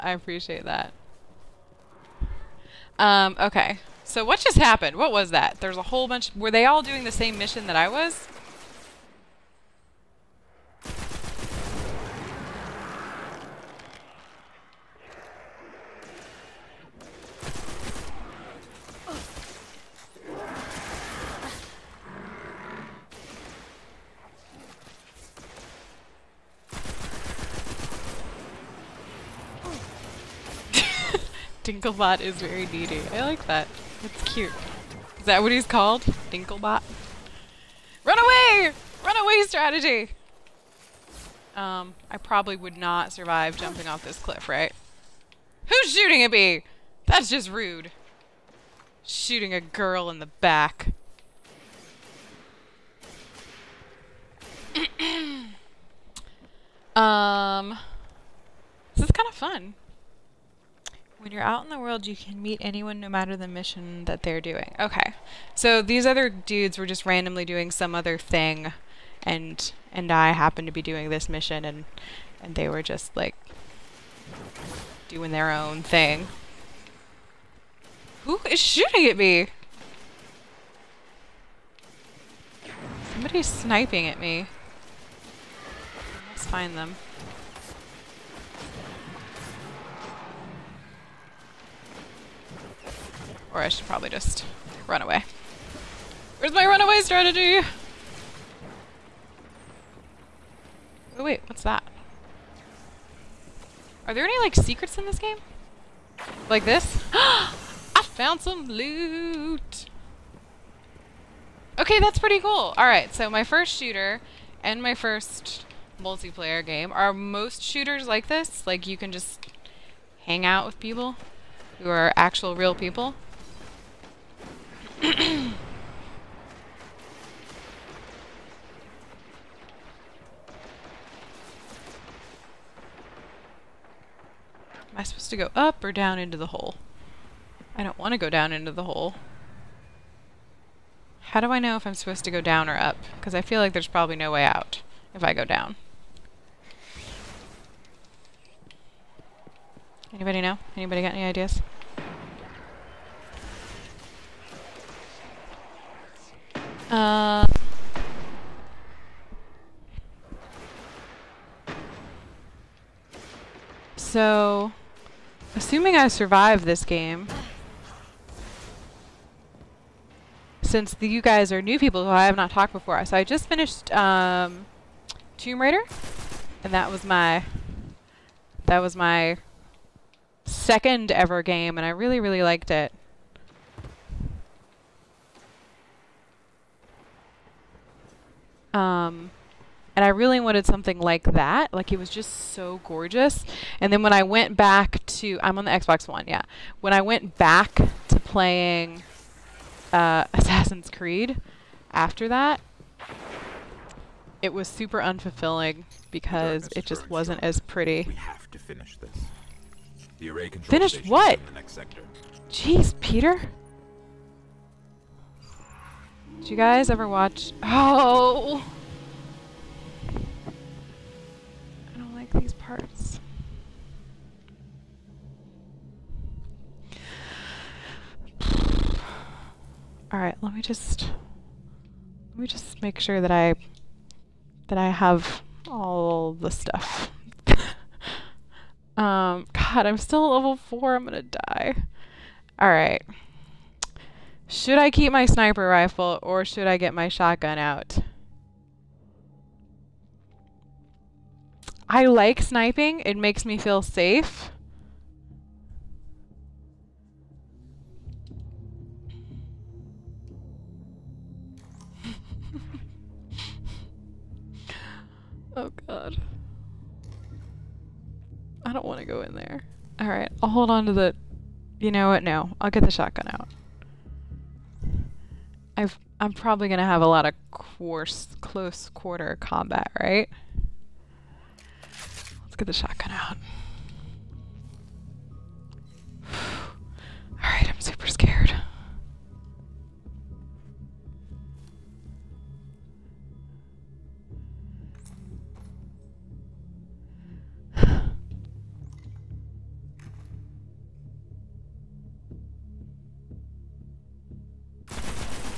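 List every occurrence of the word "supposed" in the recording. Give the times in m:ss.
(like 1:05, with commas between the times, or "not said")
2:15, 2:21.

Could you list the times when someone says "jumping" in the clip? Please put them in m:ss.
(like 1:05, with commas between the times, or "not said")
0:43.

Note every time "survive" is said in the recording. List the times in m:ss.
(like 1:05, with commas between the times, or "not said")
0:43, 2:46.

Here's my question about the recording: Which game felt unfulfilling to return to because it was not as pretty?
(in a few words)
Assassin's Creed.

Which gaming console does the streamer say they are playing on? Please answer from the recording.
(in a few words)
Xbox One.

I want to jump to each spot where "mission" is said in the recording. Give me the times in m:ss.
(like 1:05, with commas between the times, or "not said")
0:07, 1:03, 1:11.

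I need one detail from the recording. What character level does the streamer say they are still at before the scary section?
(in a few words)
4.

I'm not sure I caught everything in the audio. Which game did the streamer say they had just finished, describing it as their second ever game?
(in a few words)
Tomb Raider.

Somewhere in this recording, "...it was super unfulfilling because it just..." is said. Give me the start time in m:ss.
3:24.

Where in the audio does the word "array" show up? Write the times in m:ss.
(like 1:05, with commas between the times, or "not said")
3:30.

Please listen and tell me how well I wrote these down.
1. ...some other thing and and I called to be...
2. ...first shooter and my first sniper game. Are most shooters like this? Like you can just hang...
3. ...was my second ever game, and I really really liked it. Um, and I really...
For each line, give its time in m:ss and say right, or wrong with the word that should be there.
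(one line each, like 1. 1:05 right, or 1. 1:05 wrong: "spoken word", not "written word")
1. 1:07 wrong: "happened", not "called"
2. 1:53 wrong: "multiplayer", not "sniper"
3. 2:58 right.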